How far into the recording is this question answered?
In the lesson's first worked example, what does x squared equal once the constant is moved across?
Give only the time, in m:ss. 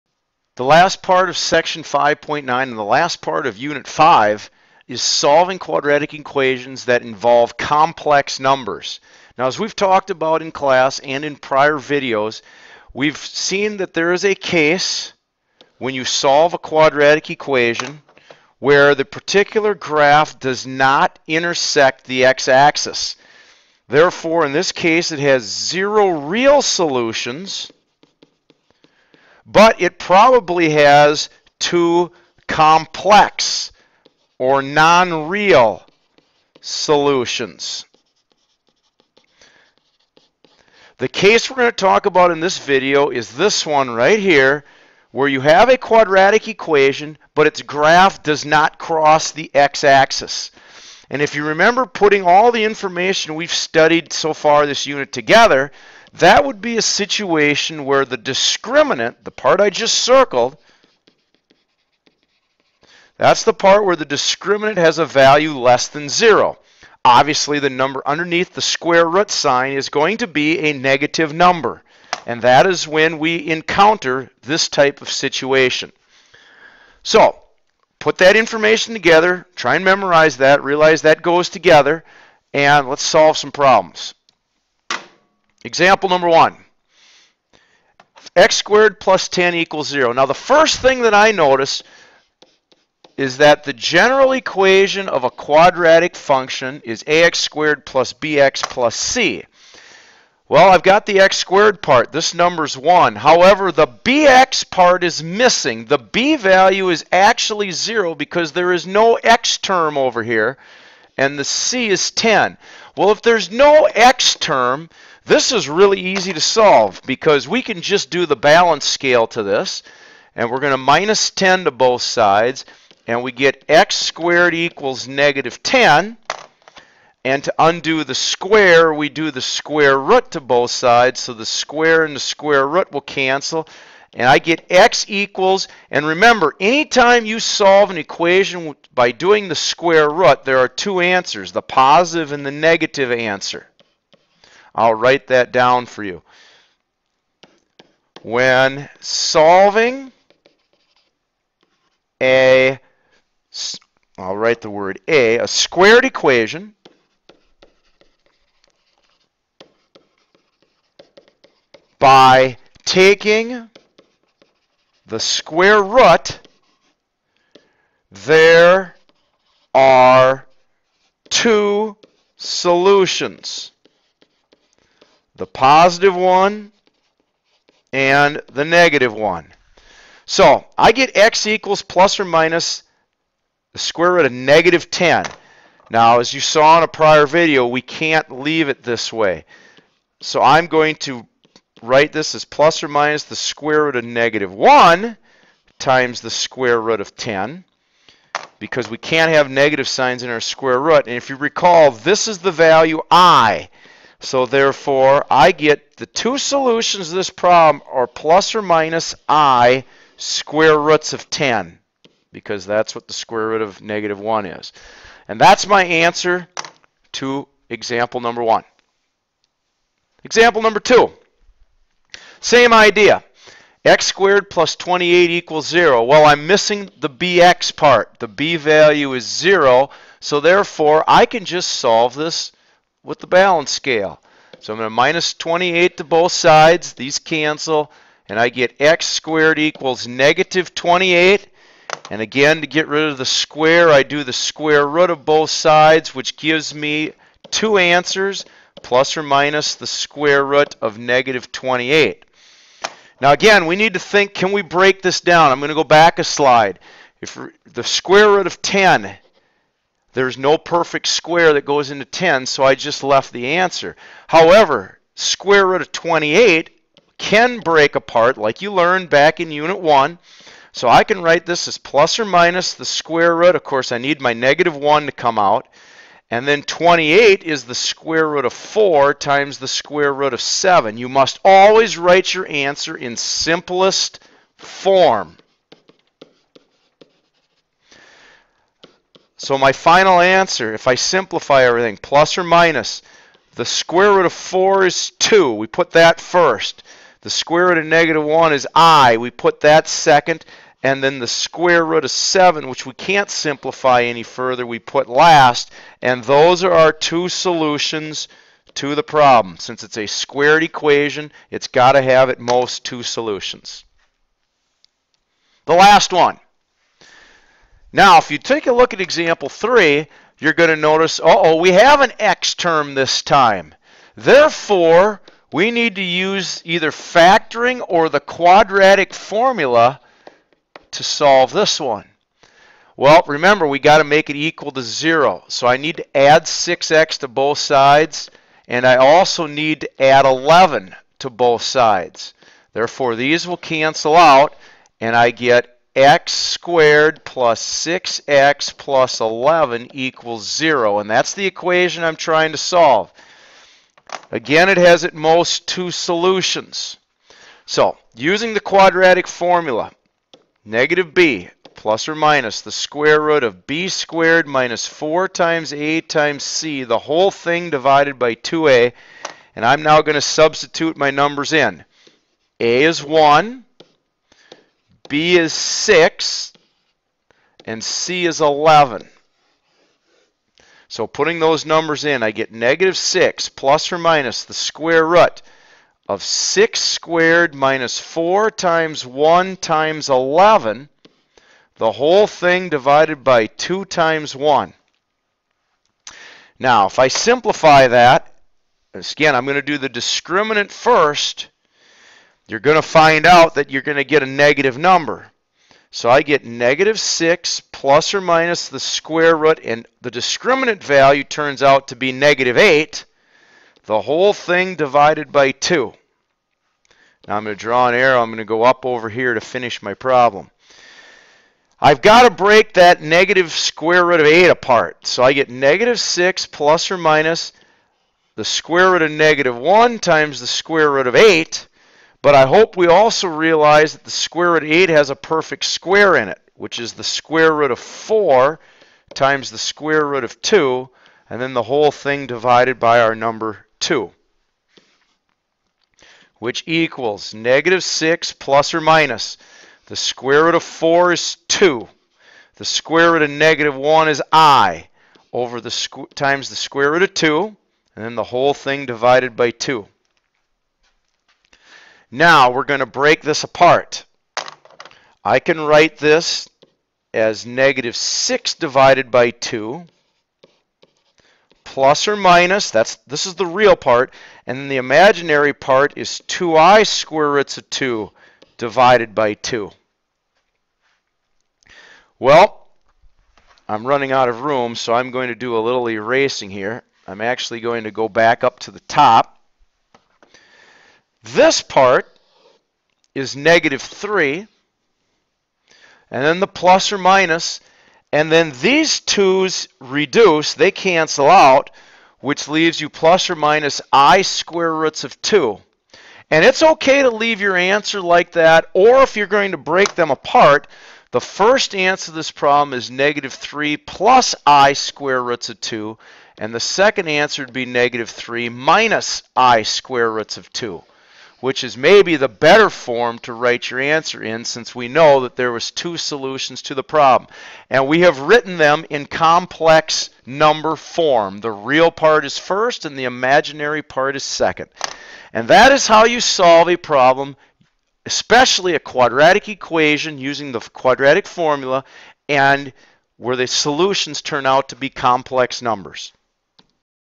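2:03.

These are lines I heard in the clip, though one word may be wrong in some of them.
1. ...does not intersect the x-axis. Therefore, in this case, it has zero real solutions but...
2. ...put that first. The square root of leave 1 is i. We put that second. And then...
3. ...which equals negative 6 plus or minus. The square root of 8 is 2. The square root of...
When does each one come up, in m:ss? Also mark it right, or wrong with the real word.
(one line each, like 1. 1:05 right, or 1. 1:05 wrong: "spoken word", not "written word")
1. 0:20 right
2. 4:55 wrong: "negative", not "leave"
3. 7:26 wrong: "4", not "8".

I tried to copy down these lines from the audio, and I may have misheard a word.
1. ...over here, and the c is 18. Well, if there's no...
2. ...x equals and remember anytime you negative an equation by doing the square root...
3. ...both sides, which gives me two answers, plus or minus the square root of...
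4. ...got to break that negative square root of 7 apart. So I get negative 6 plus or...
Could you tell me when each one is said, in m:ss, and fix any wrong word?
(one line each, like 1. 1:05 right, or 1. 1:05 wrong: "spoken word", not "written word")
1. 1:49 wrong: "10", not "18"
2. 2:14 wrong: "solve", not "negative"
3. 4:05 right
4. 7:02 wrong: "8", not "7".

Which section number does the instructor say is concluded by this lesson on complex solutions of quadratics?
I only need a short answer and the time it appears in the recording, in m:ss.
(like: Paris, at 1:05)
5.9, at 0:01.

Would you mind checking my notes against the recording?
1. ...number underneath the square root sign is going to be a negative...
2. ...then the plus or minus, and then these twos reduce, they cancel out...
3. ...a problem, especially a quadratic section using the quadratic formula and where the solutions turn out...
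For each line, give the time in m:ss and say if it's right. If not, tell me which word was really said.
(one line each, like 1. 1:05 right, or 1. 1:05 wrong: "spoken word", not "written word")
1. 1:07 right
2. 8:16 right
3. 8:56 wrong: "equation", not "section".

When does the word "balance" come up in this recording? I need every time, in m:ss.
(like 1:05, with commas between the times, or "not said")
1:58, 3:53.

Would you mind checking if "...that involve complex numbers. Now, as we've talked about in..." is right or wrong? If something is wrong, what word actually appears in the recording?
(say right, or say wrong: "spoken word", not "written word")
right.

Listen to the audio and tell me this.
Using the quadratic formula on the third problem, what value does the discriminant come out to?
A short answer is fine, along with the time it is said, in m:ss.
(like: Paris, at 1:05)
-8, at 6:52.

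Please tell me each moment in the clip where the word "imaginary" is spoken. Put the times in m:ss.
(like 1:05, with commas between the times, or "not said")
7:54, 8:53.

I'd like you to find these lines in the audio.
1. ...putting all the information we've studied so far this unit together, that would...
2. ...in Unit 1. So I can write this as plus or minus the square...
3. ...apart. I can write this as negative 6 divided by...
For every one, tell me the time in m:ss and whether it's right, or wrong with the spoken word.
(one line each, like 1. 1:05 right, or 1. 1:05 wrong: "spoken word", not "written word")
1. 0:51 right
2. 4:29 right
3. 7:43 right.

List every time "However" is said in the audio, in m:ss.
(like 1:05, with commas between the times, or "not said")
1:43, 4:24.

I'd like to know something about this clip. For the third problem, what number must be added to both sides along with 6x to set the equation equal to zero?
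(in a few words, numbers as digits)
11.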